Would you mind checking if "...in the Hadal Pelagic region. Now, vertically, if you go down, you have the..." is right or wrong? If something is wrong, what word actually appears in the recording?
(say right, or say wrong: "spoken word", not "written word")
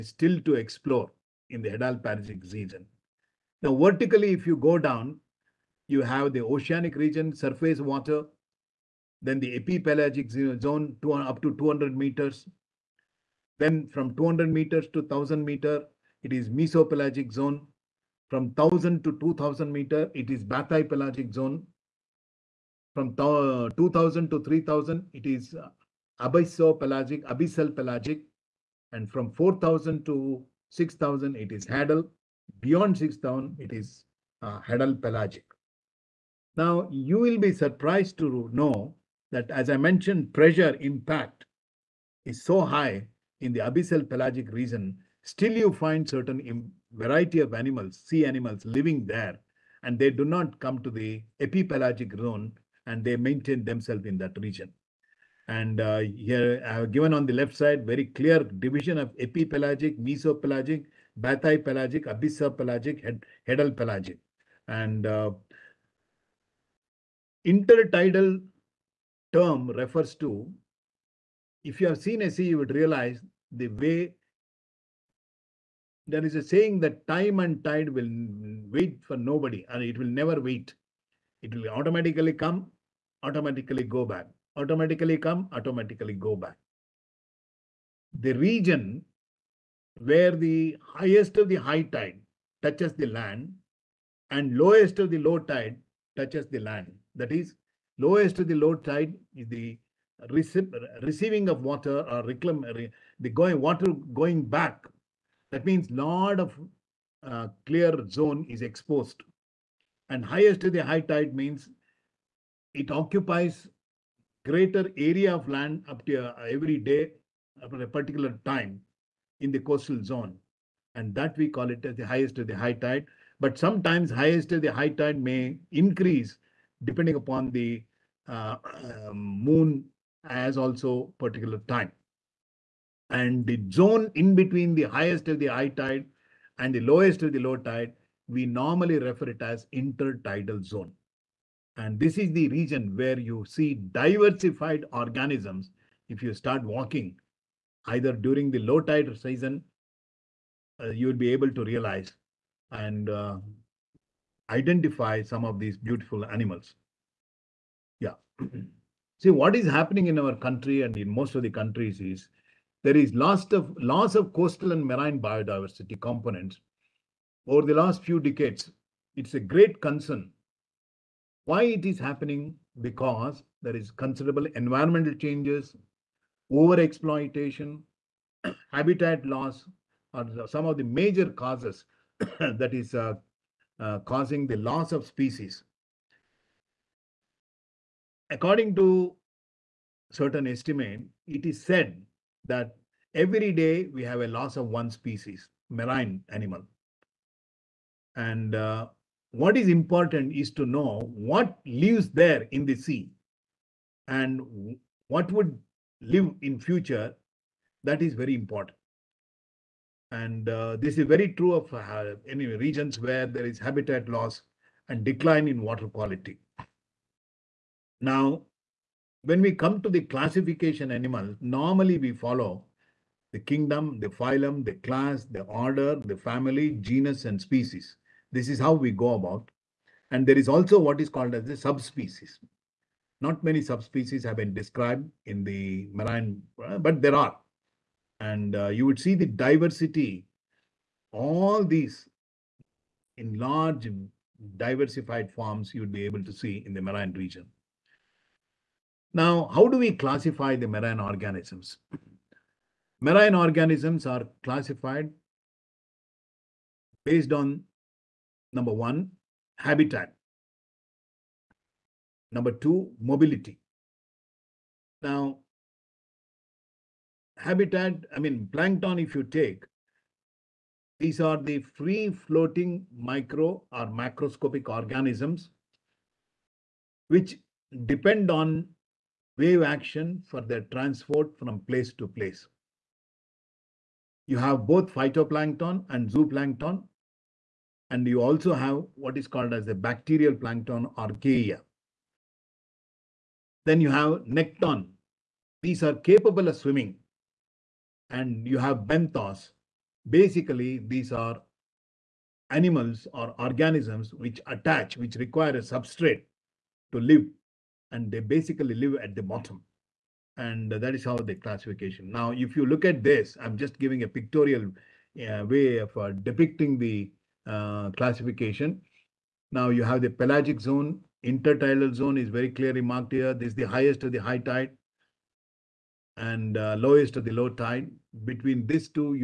right.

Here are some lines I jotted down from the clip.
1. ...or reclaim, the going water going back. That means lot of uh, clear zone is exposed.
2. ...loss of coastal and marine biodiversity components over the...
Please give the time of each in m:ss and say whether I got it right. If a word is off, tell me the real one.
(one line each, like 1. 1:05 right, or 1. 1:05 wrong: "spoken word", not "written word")
1. 1:42 right
2. 2:43 right.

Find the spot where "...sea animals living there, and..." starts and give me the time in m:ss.
0:48.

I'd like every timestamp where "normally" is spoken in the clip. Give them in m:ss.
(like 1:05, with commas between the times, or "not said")
2:18, 3:41.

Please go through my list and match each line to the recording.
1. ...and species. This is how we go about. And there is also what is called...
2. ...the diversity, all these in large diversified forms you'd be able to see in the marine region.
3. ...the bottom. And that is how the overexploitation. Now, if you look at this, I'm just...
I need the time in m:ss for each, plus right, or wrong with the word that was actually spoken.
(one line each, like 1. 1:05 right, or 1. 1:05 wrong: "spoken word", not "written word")
1. 3:47 right
2. 3:59 right
3. 5:09 wrong: "classification", not "overexploitation".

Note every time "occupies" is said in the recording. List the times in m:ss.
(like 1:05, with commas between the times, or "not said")
1:52.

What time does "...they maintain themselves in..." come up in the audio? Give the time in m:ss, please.
0:53.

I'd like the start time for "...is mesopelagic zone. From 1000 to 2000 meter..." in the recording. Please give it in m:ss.
0:16.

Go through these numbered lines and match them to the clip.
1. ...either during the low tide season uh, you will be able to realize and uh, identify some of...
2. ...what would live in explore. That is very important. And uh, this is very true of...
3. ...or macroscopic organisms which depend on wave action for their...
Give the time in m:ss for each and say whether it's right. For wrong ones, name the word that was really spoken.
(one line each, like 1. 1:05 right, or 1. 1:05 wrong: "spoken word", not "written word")
1. 2:27 right
2. 3:25 wrong: "future", not "explore"
3. 4:33 right.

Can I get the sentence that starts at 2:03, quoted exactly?
But sometimes highest to the high tide may increase depending upon the uh, um, moon as also particular time.